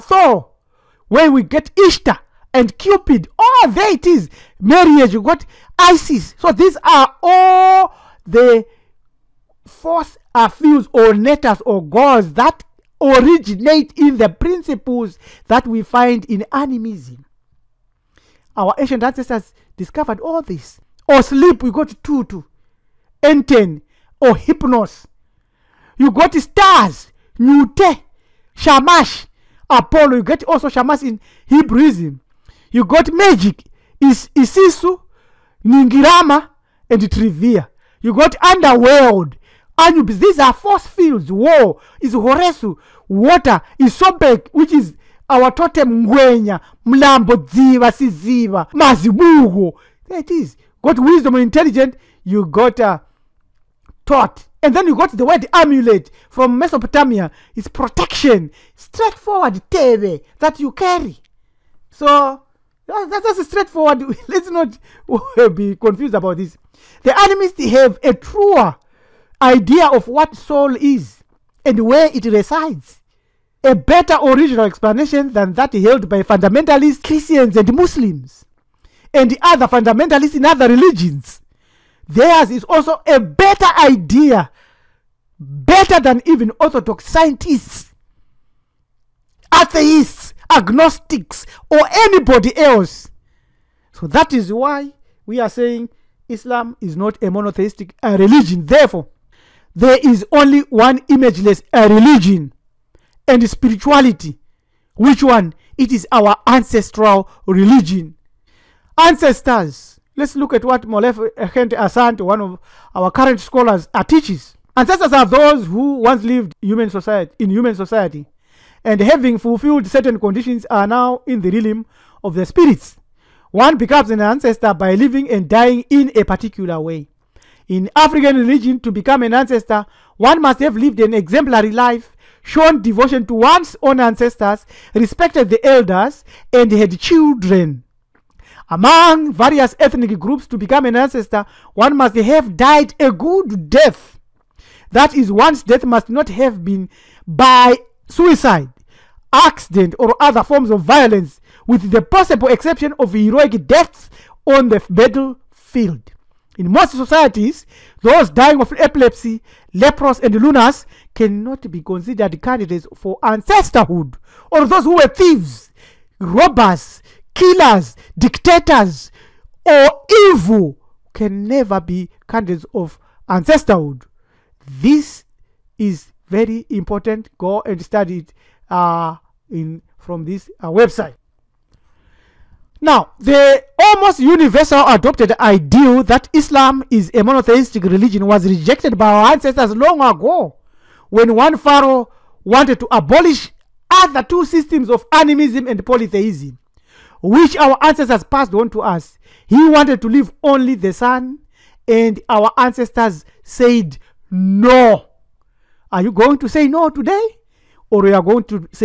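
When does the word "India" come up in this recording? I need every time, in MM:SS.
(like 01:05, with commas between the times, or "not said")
not said.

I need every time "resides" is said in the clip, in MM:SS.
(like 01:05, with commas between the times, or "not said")
01:12.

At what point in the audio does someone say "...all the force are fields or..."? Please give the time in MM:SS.
00:07.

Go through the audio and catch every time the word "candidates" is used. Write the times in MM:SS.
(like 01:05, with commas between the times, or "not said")
02:42, 02:52.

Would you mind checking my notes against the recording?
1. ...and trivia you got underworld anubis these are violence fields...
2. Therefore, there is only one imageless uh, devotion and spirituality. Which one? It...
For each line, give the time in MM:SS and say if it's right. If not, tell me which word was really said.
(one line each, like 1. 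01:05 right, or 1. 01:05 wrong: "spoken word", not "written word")
1. 00:36 wrong: "force", not "violence"
2. 01:38 wrong: "religion", not "devotion".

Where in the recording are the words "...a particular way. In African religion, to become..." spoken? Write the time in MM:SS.
02:06.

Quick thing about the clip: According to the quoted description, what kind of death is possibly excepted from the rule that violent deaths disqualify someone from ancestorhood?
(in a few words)
heroic deaths on the battlefield.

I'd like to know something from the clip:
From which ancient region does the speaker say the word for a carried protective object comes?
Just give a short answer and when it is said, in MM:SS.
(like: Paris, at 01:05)
Mesopotamia, at 00:56.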